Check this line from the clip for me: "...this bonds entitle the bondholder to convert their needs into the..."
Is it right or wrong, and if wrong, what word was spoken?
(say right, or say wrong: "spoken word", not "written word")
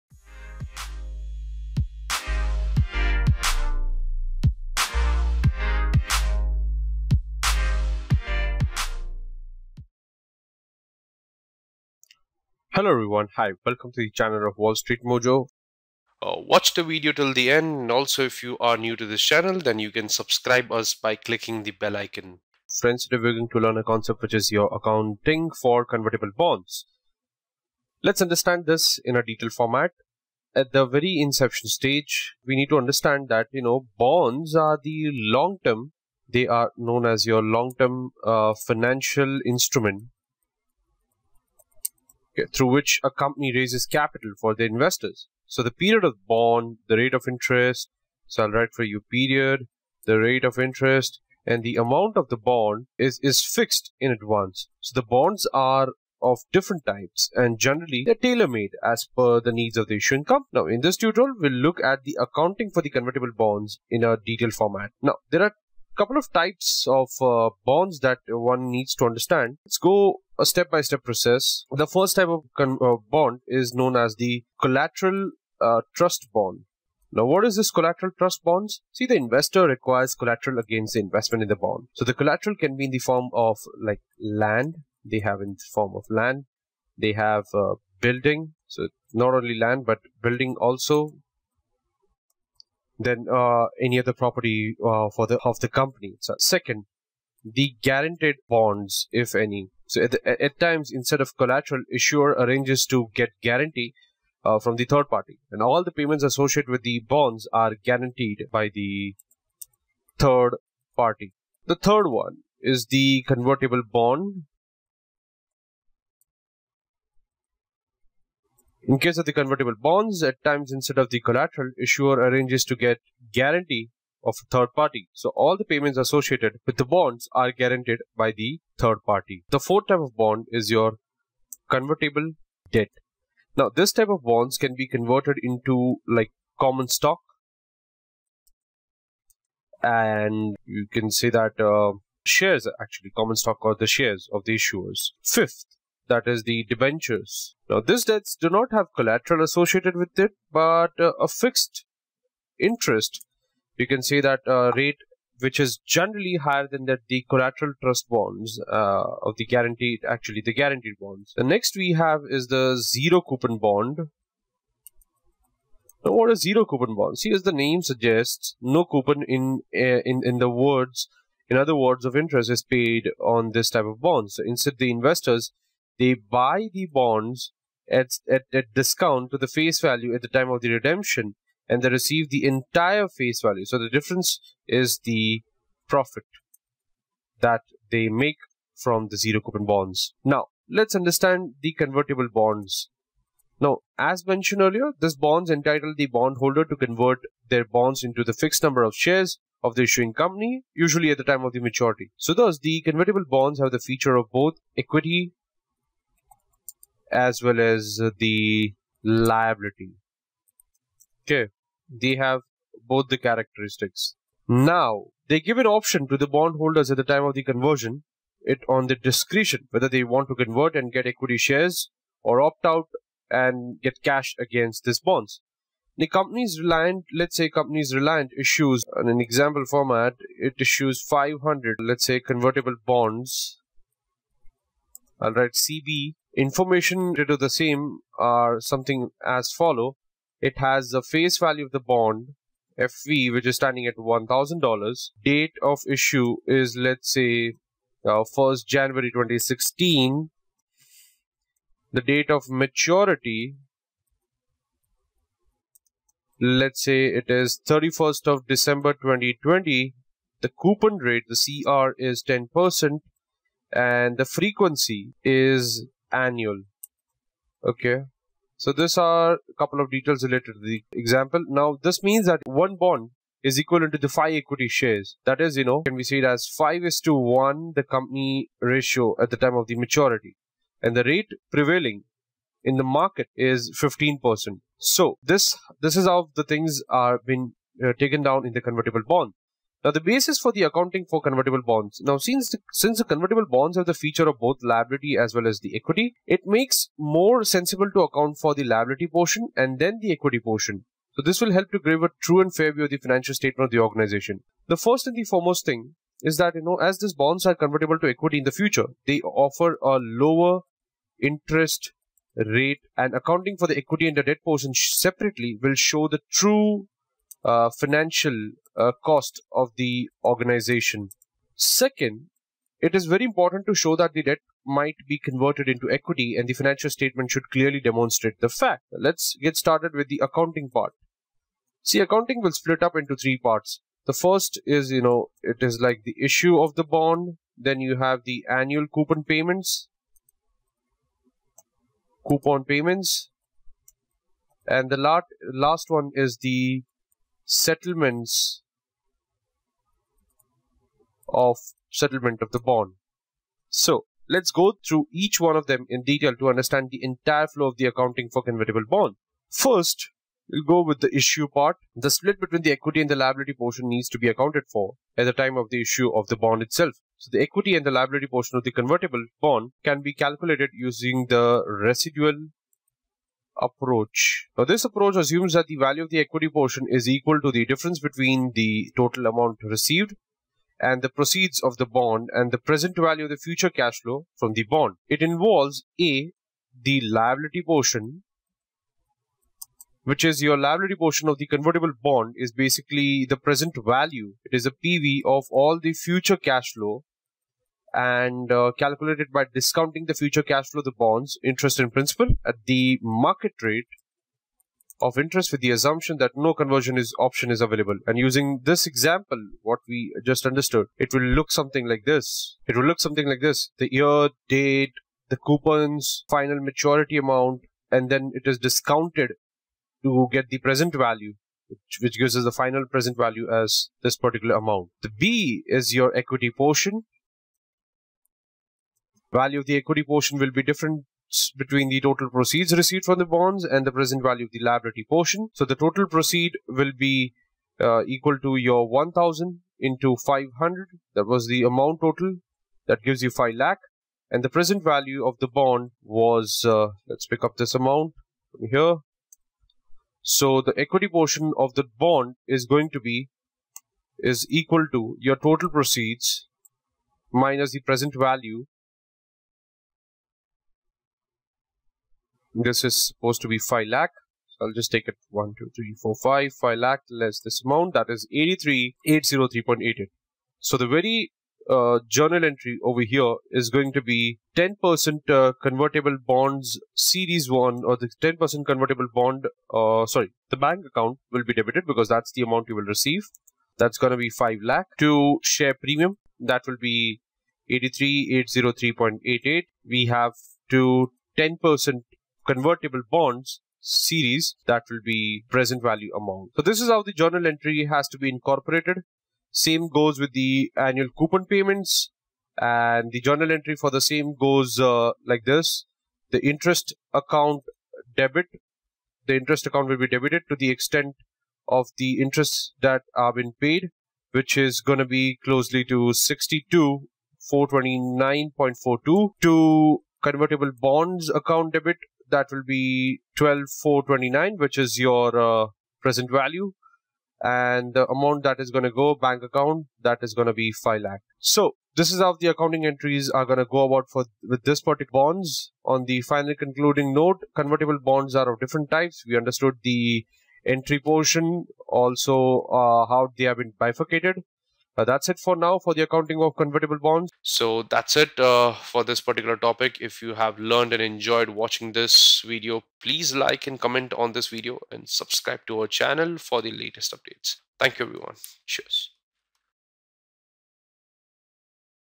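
wrong: "bonds", not "needs".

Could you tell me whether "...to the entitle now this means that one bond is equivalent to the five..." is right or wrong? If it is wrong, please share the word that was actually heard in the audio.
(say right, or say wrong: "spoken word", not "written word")
wrong: "example", not "entitle".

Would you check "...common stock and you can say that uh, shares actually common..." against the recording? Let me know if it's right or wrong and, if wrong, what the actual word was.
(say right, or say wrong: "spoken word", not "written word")
right.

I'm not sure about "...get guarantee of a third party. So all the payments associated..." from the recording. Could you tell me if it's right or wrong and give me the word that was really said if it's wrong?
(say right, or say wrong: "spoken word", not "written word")
right.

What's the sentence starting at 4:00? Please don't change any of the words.
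It has the face value of the bond, FV, which is standing at $1,000.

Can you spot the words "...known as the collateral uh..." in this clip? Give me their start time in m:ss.
1:13.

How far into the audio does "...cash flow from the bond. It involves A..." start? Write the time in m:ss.
6:23.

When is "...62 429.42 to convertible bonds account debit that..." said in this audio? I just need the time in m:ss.
8:36.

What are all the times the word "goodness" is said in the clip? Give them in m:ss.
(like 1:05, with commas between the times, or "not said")
not said.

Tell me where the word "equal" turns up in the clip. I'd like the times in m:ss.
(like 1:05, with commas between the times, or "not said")
6:17, 7:18, 7:34.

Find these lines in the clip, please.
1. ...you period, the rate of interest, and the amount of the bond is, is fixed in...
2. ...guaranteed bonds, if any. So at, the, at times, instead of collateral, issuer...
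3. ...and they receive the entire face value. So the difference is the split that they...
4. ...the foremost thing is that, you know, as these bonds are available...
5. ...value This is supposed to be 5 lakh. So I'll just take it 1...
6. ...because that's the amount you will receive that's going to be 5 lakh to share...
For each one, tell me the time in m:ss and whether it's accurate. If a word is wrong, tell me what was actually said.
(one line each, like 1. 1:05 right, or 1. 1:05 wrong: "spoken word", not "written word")
1. 0:48 right
2. 1:37 right
3. 3:01 wrong: "profit", not "split"
4. 5:05 wrong: "convertible", not "available"
5. 7:38 right
6. 8:01 right.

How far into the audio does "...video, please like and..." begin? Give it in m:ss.
9:12.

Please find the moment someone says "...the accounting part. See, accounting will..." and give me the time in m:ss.
5:30.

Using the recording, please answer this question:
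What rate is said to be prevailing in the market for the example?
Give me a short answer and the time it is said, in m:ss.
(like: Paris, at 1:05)
15%, at 4:43.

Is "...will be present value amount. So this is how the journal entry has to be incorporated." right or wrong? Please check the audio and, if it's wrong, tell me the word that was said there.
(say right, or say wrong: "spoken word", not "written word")
right.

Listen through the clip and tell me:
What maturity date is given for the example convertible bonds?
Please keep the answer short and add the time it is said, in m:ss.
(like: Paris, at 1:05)
31 December 2020, at 4:17.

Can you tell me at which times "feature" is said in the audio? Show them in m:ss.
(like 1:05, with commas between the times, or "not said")
3:23, 4:53.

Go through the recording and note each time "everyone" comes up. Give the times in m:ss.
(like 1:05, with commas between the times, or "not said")
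0:12, 9:18.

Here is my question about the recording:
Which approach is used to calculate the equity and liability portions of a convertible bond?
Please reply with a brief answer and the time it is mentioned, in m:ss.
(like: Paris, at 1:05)
residual approach, at 6:11.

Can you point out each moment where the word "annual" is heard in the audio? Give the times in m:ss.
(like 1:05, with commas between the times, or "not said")
4:26, 5:38, 8:20.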